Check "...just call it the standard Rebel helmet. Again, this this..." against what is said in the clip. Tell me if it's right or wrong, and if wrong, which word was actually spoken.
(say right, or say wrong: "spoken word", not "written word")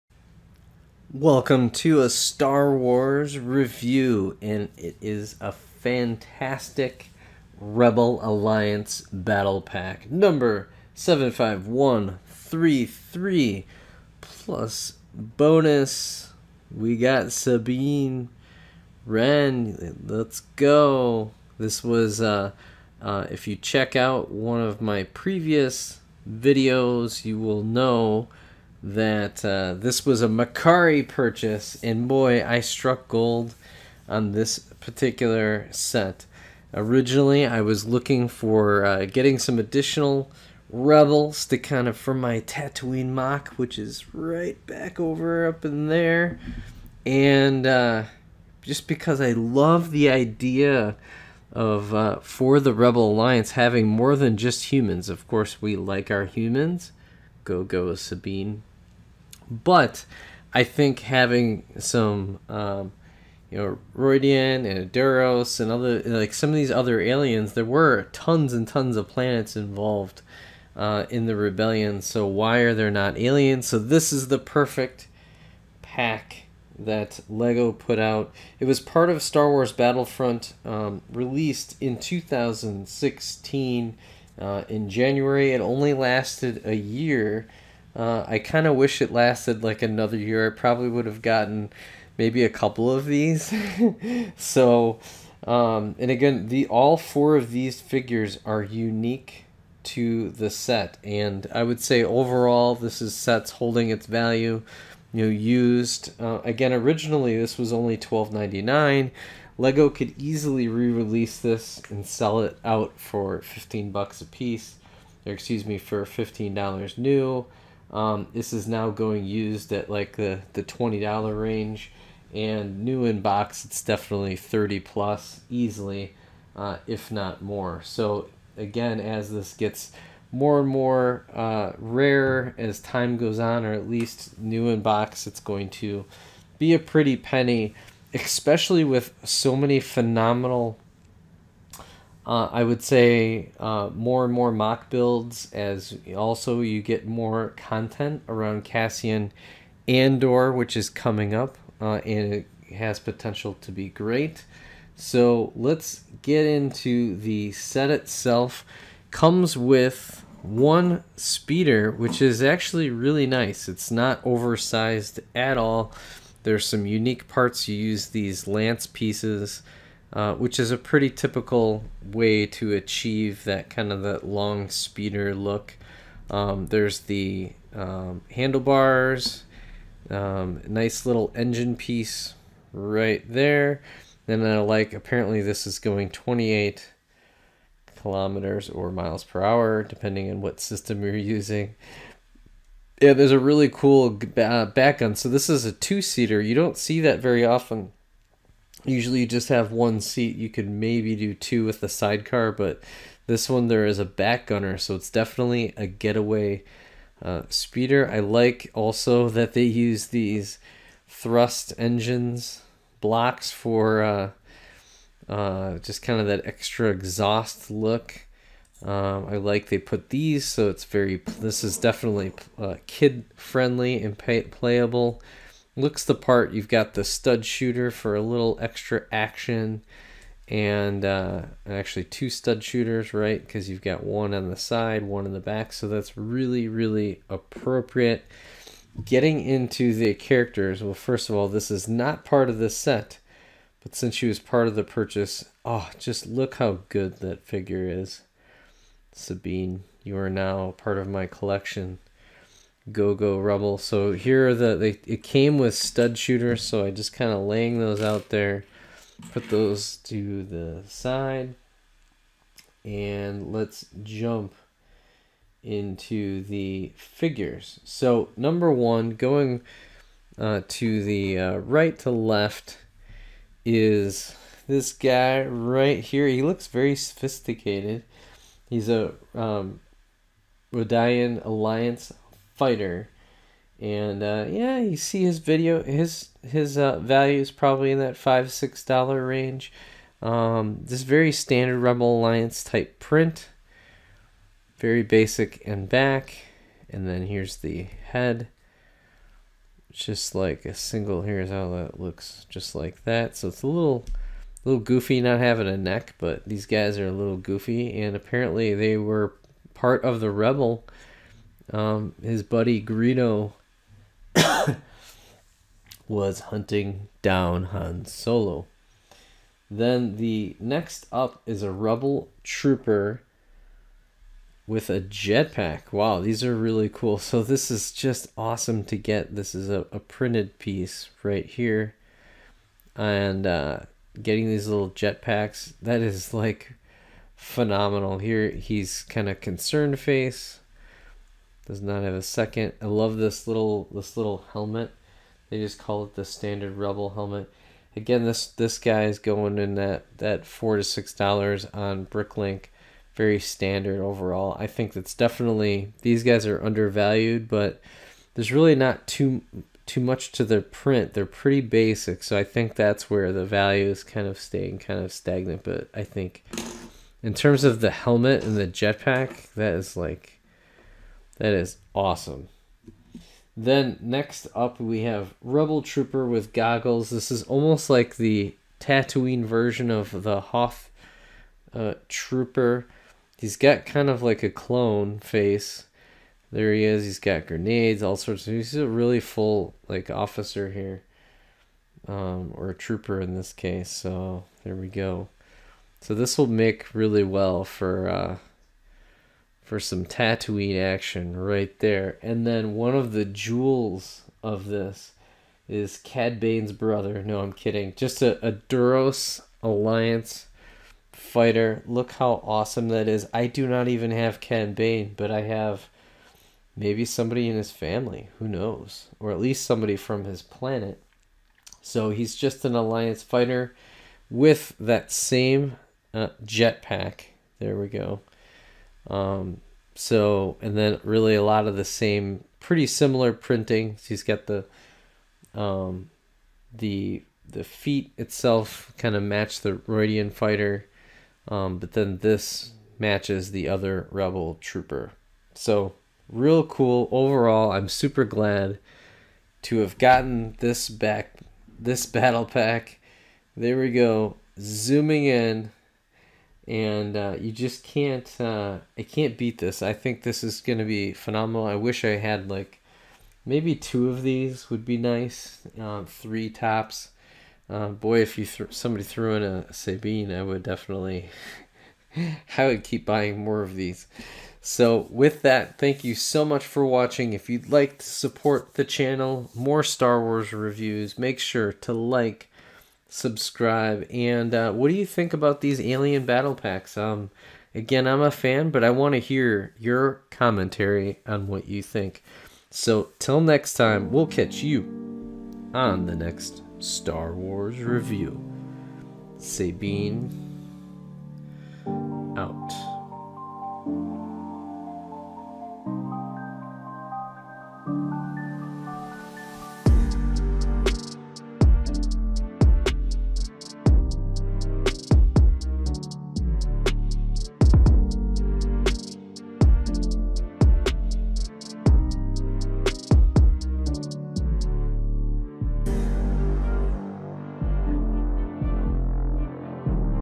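right.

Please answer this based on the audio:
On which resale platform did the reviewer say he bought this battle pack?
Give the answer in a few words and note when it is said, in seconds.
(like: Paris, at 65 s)
Mercari, at 30 s.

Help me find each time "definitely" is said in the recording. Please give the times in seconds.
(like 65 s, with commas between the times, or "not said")
123 s, 205 s, 221 s, 355 s, 470 s.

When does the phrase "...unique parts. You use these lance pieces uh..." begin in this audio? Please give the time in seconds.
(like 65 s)
166 s.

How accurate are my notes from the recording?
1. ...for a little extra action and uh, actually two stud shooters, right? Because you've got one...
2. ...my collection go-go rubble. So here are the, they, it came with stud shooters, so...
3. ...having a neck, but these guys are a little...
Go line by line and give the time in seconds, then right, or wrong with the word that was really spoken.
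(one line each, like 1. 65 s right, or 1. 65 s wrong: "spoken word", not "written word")
1. 227 s right
2. 251 s right
3. 305 s right.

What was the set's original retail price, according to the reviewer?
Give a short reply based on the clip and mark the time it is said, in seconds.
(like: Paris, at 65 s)
$12.99, at 107 s.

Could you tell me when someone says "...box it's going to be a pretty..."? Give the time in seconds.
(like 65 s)
134 s.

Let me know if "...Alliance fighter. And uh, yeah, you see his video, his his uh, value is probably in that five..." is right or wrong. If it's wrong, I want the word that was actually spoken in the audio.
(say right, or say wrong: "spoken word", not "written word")
right.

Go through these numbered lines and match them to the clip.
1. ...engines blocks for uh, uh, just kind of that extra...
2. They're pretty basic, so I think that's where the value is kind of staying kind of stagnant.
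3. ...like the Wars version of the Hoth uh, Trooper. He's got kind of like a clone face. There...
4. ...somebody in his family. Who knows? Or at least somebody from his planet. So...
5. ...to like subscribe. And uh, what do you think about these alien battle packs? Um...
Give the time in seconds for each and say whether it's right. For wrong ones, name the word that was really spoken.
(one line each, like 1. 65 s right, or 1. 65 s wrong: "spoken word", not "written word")
1. 211 s right
2. 361 s right
3. 377 s wrong: "Tatooine", not "Wars"
4. 417 s right
5. 481 s right.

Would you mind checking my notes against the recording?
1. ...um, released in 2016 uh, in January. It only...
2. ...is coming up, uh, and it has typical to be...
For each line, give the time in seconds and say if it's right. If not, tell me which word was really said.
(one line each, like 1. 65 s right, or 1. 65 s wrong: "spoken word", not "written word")
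1. 80 s right
2. 150 s wrong: "potential", not "typical".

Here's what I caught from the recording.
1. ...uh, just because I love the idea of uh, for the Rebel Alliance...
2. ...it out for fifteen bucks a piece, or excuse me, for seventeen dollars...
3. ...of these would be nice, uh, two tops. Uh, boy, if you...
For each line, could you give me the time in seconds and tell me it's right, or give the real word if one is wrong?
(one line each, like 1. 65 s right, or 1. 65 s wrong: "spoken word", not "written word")
1. 47 s right
2. 112 s wrong: "fifteen", not "seventeen"
3. 464 s wrong: "three", not "two".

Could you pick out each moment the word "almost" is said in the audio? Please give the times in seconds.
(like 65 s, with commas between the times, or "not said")
377 s.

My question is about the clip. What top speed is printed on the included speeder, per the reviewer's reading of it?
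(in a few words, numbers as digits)
28.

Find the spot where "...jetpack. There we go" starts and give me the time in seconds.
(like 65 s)
426 s.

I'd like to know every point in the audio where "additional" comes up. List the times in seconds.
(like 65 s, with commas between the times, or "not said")
39 s.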